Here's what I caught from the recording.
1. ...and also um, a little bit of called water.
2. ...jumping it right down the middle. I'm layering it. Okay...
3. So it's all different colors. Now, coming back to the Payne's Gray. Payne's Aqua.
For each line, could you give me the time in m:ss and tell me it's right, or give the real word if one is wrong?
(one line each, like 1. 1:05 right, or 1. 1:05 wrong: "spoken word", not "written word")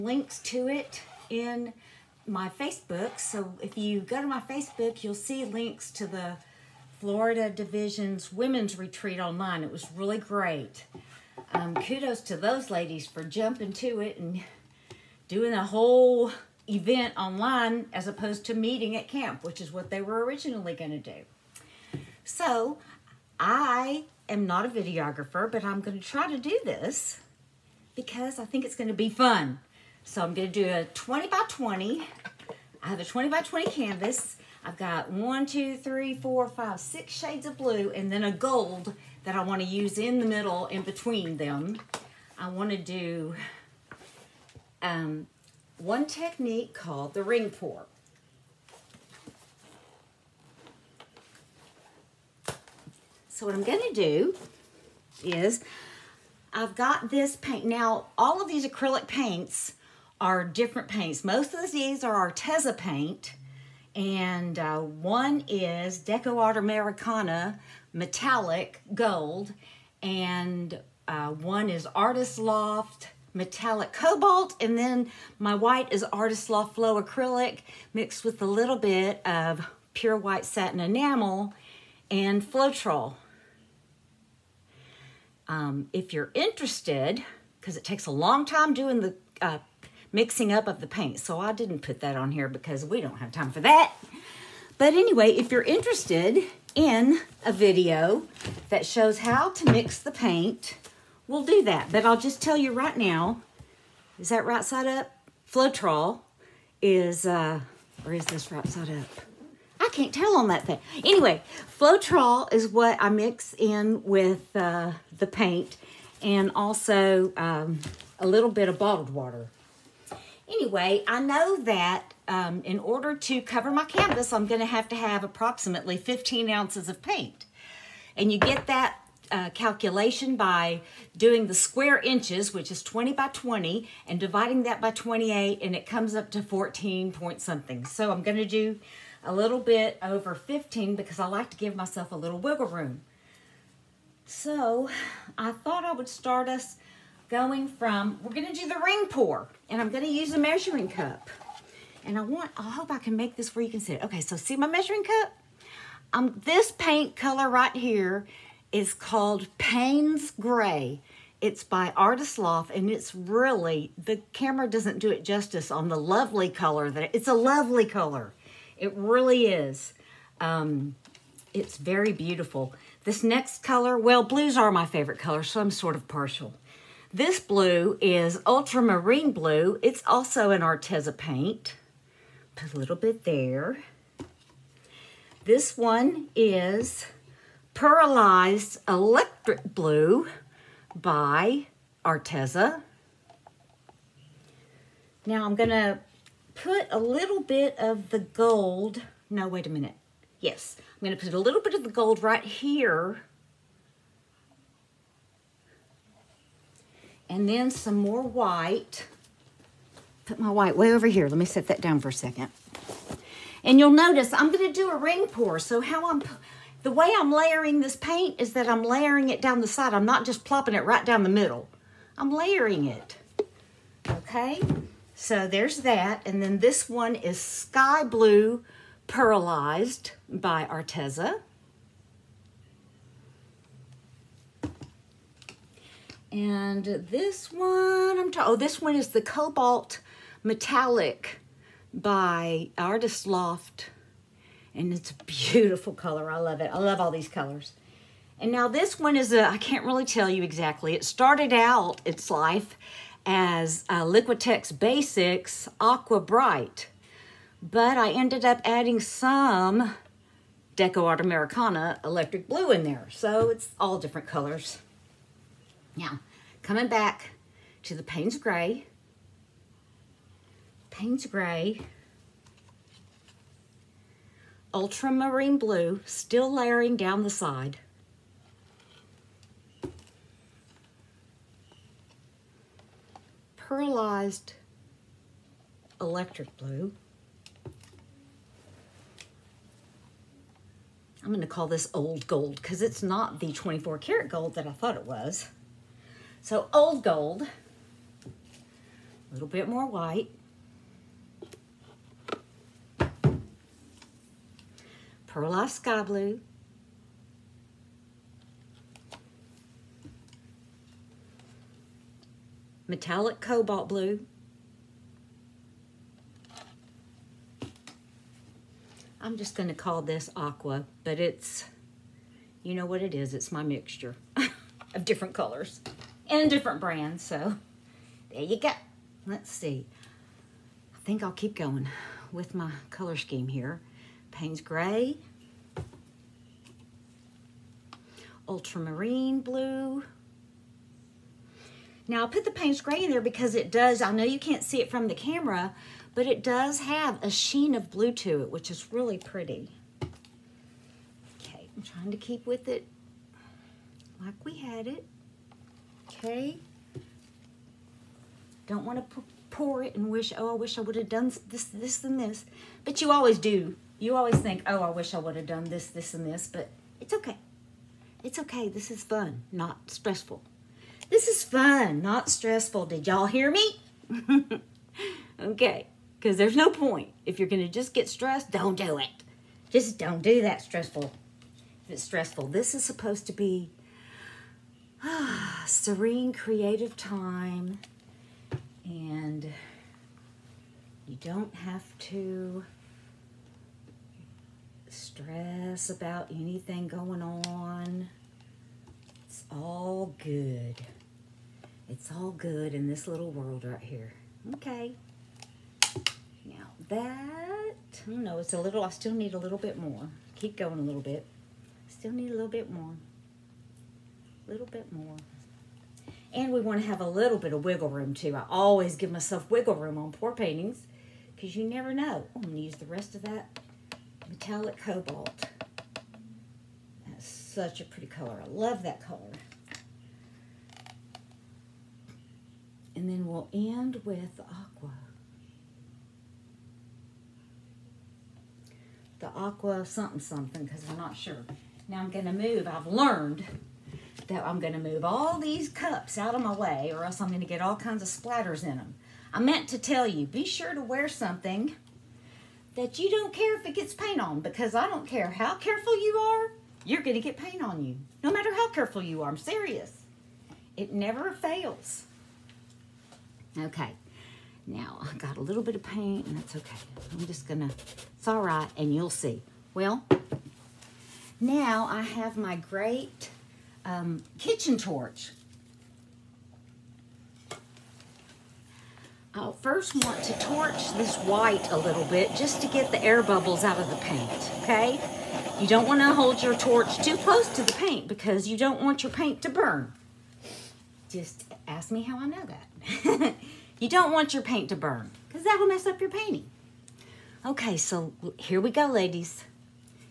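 1. 1:56 wrong: "bottled", not "called"
2. 3:40 wrong: "plopping", not "jumping"
3. 4:23 wrong: "Gray", not "Aqua".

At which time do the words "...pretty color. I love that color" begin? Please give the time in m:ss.
7:07.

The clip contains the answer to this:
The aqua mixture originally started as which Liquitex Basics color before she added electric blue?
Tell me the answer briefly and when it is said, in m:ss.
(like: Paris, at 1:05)
Aqua Bright, at 4:15.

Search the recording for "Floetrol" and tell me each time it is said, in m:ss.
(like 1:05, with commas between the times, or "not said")
1:22, 1:45, 1:51.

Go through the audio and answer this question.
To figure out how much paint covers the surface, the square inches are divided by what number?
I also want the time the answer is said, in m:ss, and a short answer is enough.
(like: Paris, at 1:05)
28, at 2:14.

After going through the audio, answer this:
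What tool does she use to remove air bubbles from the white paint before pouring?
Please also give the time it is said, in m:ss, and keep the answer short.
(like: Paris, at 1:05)
kitchen torch, at 7:54.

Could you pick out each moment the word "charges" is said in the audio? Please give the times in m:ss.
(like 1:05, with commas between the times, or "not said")
not said.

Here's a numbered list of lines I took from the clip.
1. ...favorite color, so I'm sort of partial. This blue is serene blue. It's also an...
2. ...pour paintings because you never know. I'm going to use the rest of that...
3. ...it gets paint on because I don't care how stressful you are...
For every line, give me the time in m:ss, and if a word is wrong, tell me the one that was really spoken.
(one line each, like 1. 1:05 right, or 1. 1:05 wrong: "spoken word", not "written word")
1. 2:54 wrong: "ultramarine", not "serene"
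2. 7:00 right
3. 7:33 wrong: "careful", not "stressful".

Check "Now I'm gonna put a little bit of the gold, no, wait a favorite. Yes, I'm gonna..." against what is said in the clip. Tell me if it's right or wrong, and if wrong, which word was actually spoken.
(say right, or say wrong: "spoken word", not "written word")
wrong: "minute", not "favorite".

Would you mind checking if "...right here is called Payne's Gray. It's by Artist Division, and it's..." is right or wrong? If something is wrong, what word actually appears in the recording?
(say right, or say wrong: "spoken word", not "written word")
wrong: "Loft", not "Division".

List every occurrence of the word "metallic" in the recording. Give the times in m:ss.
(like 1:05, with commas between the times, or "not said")
1:07, 1:13, 4:00, 5:12, 7:04.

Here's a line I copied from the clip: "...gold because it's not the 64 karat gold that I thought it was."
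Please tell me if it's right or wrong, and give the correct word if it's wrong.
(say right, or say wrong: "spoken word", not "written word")
wrong: "24", not "64".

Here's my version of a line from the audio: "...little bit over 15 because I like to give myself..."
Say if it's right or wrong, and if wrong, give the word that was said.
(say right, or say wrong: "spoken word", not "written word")
right.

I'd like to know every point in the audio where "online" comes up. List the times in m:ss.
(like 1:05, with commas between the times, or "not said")
0:09, 0:17.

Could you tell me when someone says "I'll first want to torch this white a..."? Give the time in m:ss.
7:59.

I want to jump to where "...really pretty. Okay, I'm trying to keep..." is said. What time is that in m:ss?
5:48.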